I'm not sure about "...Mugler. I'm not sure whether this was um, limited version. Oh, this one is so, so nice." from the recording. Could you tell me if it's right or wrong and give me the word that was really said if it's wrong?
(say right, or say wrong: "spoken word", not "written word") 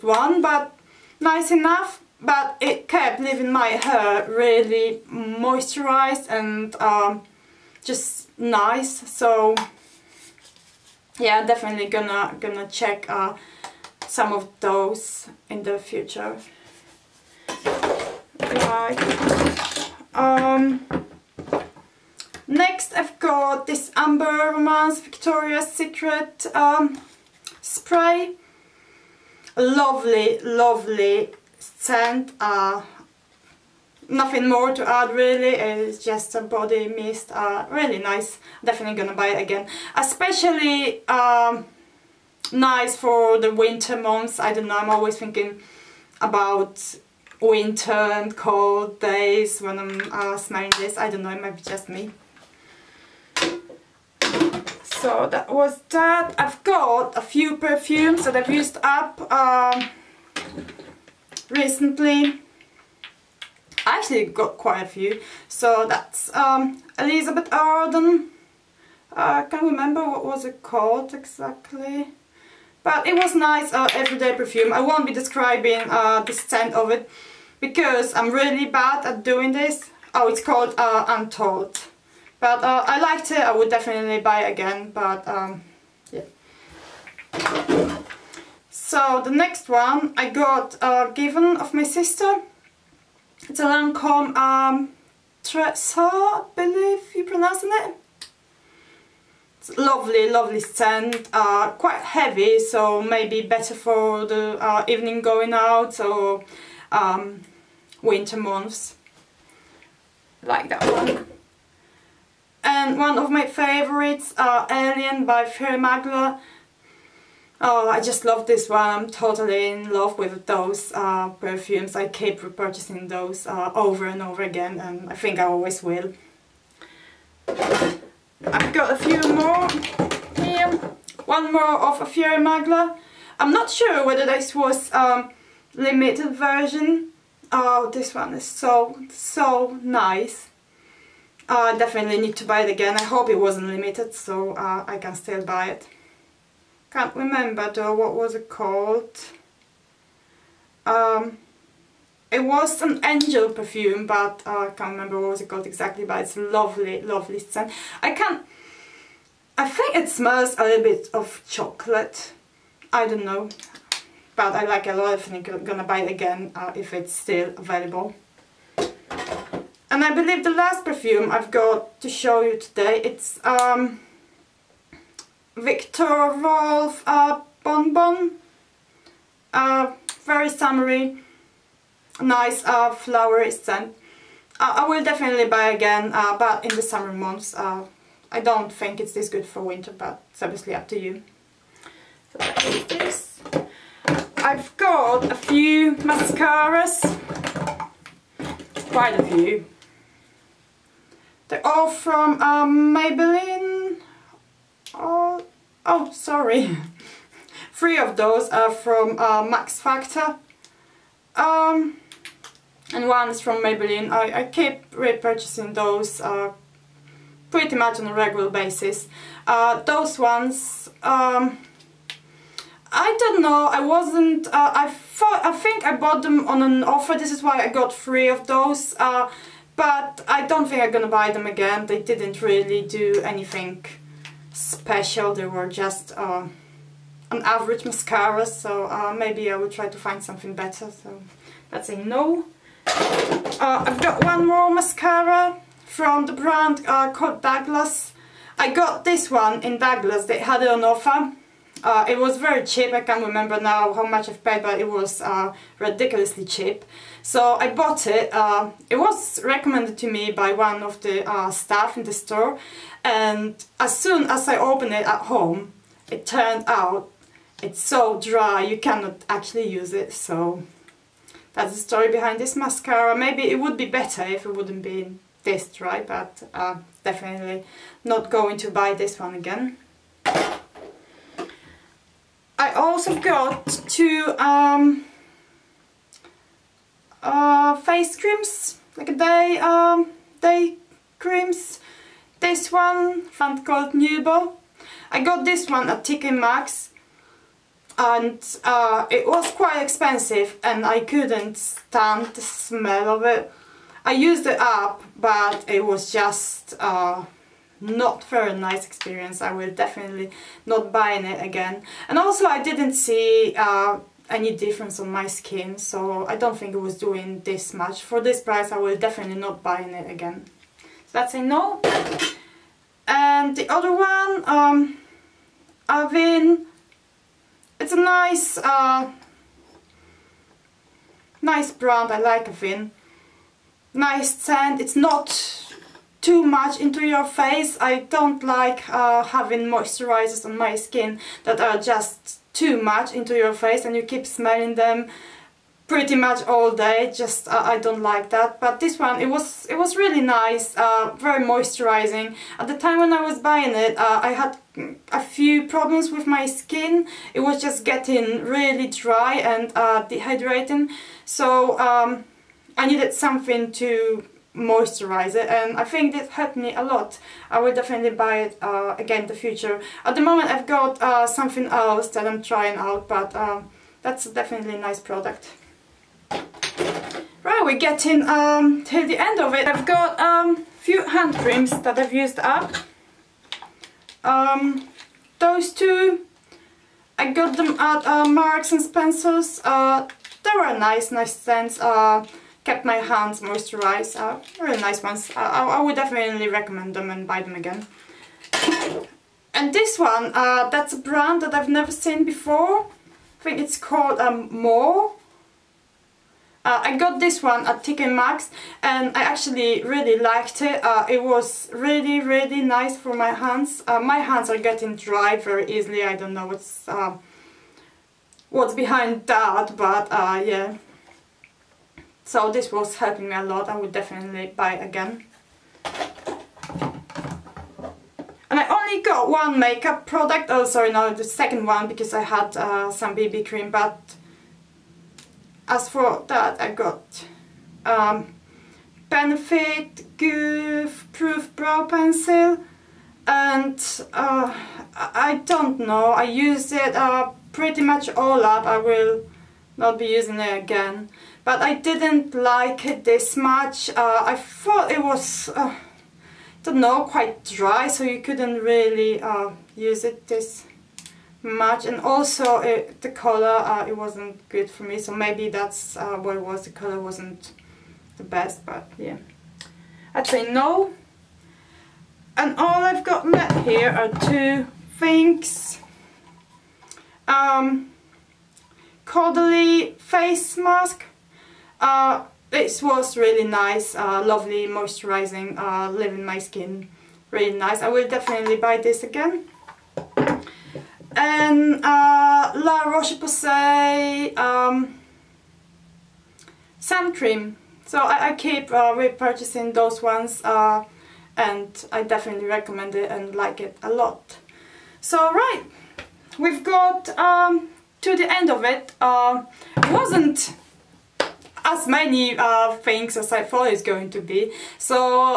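right.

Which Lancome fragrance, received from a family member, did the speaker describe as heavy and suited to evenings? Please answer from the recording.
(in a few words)
Tresor.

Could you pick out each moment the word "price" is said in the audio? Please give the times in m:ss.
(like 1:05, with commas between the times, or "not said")
5:18.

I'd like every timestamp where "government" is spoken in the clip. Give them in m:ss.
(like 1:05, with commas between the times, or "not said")
not said.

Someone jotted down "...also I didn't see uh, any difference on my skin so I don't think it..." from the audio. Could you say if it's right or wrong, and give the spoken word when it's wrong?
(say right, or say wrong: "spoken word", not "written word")
right.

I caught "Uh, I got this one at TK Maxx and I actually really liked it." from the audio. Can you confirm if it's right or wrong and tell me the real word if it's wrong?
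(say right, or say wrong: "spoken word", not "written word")
right.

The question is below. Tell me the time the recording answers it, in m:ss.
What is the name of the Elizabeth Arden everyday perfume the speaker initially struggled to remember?
1:21.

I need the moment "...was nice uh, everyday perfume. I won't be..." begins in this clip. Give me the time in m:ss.
1:13.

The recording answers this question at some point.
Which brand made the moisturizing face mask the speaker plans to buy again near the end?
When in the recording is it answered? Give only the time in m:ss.
7:59.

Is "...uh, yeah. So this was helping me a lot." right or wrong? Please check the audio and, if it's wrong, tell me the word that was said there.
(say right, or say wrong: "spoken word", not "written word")
right.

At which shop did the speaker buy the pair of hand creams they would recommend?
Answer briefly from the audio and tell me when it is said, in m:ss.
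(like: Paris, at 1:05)
Marks and Spencer's, at 6:28.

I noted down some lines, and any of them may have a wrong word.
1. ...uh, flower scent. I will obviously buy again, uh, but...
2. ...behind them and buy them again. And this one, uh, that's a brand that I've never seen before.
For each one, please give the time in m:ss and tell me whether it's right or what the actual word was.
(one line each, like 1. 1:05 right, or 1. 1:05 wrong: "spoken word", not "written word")
1. 3:02 wrong: "definitely", not "obviously"
2. 6:36 wrong: "recommend", not "behind".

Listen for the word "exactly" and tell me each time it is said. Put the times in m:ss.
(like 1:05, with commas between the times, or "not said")
1:11, 2:35.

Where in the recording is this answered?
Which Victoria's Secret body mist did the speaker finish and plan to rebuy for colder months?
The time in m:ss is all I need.
0:23.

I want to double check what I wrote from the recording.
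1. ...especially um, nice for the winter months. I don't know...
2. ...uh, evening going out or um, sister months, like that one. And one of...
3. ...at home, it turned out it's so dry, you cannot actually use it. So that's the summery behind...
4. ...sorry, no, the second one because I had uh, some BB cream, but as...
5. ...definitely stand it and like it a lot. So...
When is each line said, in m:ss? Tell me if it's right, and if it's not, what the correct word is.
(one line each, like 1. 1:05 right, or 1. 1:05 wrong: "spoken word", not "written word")
1. 0:39 right
2. 1:44 wrong: "winter", not "sister"
3. 4:25 wrong: "story", not "summery"
4. 7:10 right
5. 8:22 wrong: "recommend", not "stand".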